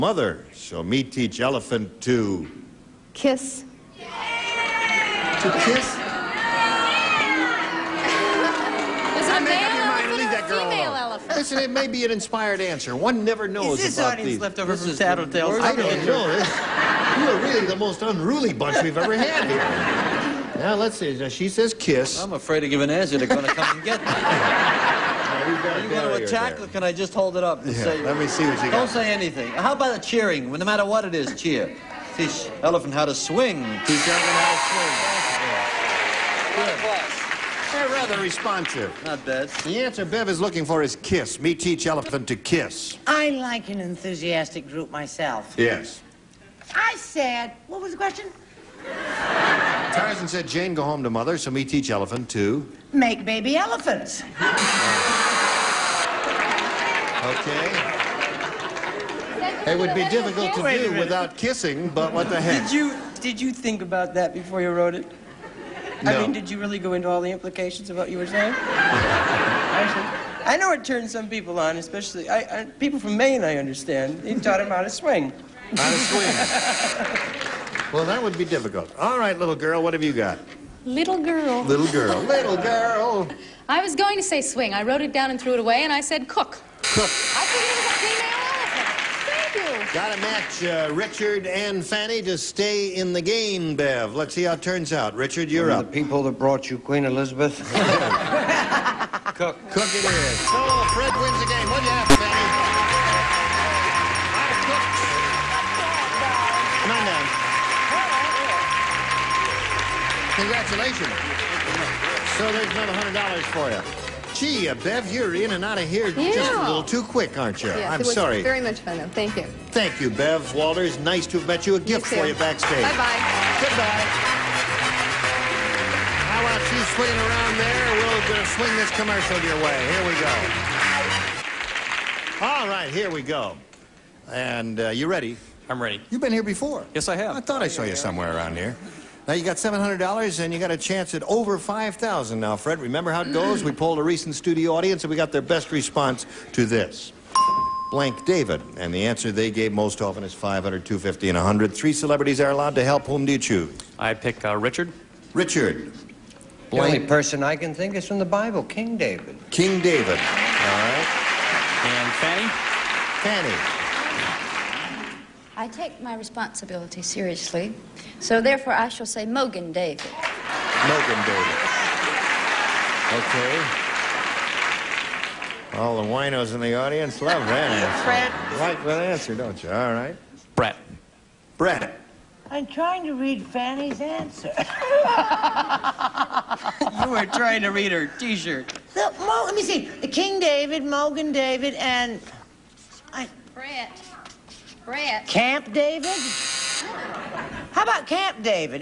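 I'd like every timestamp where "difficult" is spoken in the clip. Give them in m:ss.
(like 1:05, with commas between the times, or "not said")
1:00, 1:18.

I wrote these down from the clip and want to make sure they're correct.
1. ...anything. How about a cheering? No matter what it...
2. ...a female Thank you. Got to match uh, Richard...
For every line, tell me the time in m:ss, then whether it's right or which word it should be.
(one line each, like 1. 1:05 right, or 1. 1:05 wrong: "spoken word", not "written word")
1. 0:29 right
2. 1:27 right.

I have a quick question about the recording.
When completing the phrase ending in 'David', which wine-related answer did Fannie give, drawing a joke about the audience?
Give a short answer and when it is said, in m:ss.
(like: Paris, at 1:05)
Mogen David, at 2:49.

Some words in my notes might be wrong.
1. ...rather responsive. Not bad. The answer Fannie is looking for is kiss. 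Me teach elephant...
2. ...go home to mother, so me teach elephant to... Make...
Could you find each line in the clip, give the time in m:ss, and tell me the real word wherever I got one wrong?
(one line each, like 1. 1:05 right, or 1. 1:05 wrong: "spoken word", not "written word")
1. 0:37 wrong: "Bev", not "Fannie"
2. 0:50 right.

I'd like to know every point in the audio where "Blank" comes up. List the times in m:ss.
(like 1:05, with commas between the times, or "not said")
2:27, 2:36.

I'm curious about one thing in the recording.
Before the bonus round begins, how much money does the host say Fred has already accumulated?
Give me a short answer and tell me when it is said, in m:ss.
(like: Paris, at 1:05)
$700, at 2:19.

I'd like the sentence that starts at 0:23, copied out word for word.
They're going to come and get me.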